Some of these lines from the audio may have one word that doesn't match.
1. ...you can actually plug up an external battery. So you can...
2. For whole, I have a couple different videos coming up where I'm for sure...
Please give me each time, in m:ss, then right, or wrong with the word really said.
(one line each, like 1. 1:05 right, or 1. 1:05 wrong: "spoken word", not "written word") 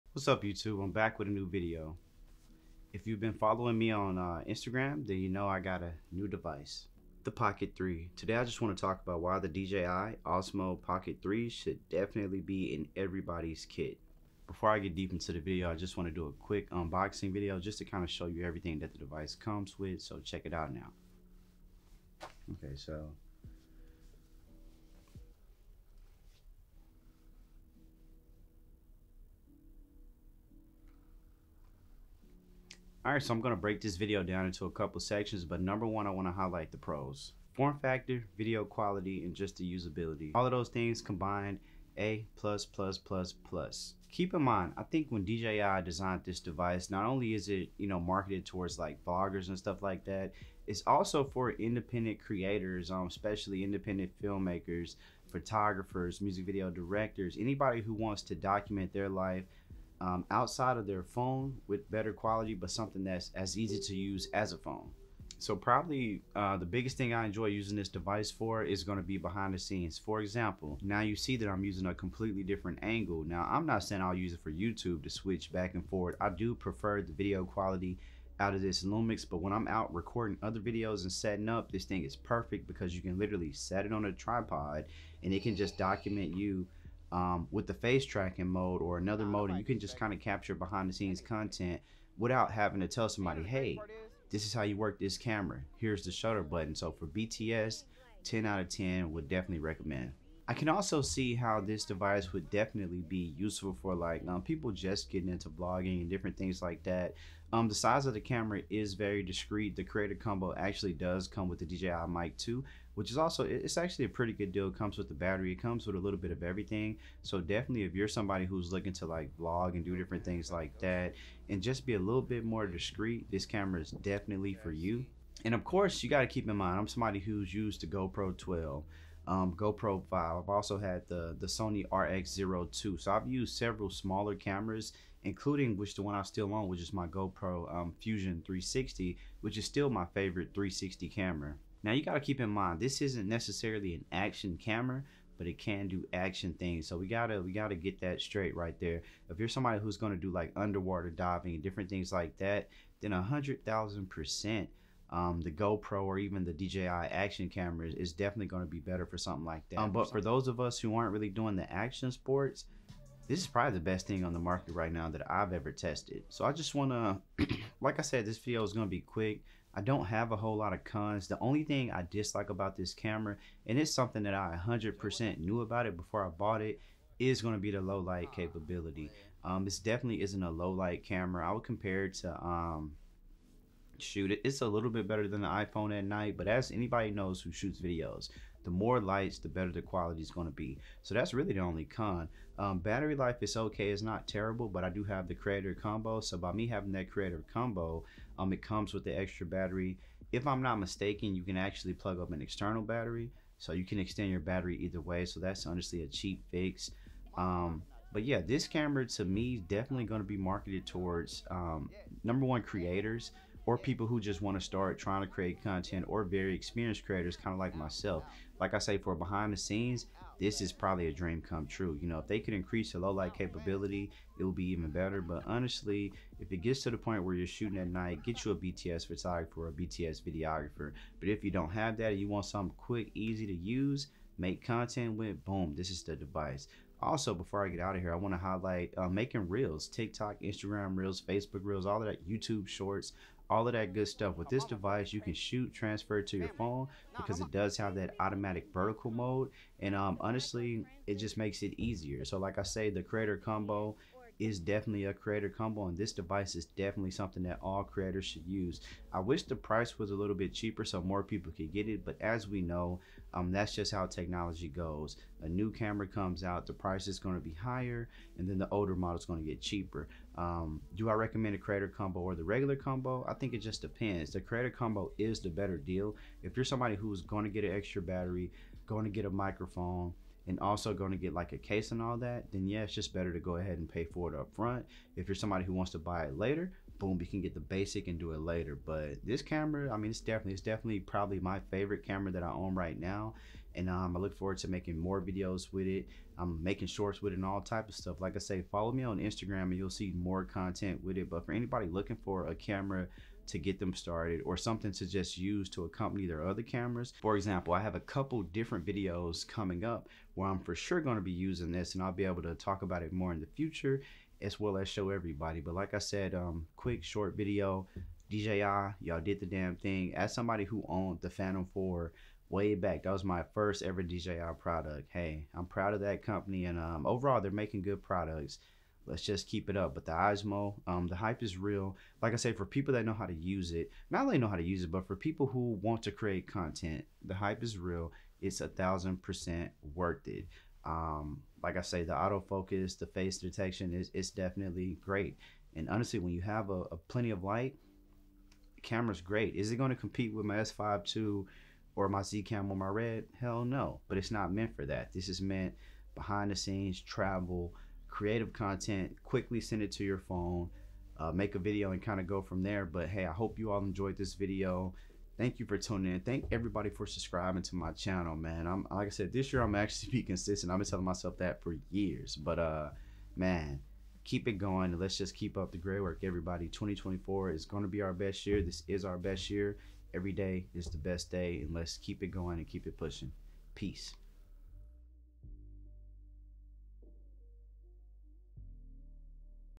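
1. 3:21 right
2. 5:07 wrong: "example", not "whole".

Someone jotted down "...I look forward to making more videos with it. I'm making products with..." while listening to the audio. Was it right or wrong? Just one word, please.
wrong.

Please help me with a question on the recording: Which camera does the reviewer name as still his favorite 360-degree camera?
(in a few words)
GoPro Fusion 360.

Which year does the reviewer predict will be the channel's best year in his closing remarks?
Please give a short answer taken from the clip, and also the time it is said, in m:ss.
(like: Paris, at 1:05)
2024, at 6:16.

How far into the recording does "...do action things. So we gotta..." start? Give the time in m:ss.
2:25.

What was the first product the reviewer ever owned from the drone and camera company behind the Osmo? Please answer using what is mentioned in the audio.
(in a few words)
Phantom 4.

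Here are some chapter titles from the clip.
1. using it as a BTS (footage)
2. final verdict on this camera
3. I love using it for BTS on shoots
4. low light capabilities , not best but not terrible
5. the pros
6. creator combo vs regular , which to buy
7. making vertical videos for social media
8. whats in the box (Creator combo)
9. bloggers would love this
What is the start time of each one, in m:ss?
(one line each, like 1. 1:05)
1. 1:20
2. 5:00
3. 1:05
4. 2:51
5. 0:50
6. 4:30
7. 3:50
8. 0:15
9. 1:58.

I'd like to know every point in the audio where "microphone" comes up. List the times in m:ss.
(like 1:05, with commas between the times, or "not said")
4:39.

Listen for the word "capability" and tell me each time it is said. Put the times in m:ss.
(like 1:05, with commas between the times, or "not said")
2:58, 3:43.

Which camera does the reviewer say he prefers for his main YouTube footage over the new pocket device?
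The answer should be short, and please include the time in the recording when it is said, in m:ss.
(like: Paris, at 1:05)
Lumix, at 1:18.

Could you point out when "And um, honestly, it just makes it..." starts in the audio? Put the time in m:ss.
4:09.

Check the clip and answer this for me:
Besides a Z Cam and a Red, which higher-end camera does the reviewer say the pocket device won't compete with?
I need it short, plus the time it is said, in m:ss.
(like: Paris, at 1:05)
S5 II, at 5:50.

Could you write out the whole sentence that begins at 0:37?
Form factor, video quality, and just the usability.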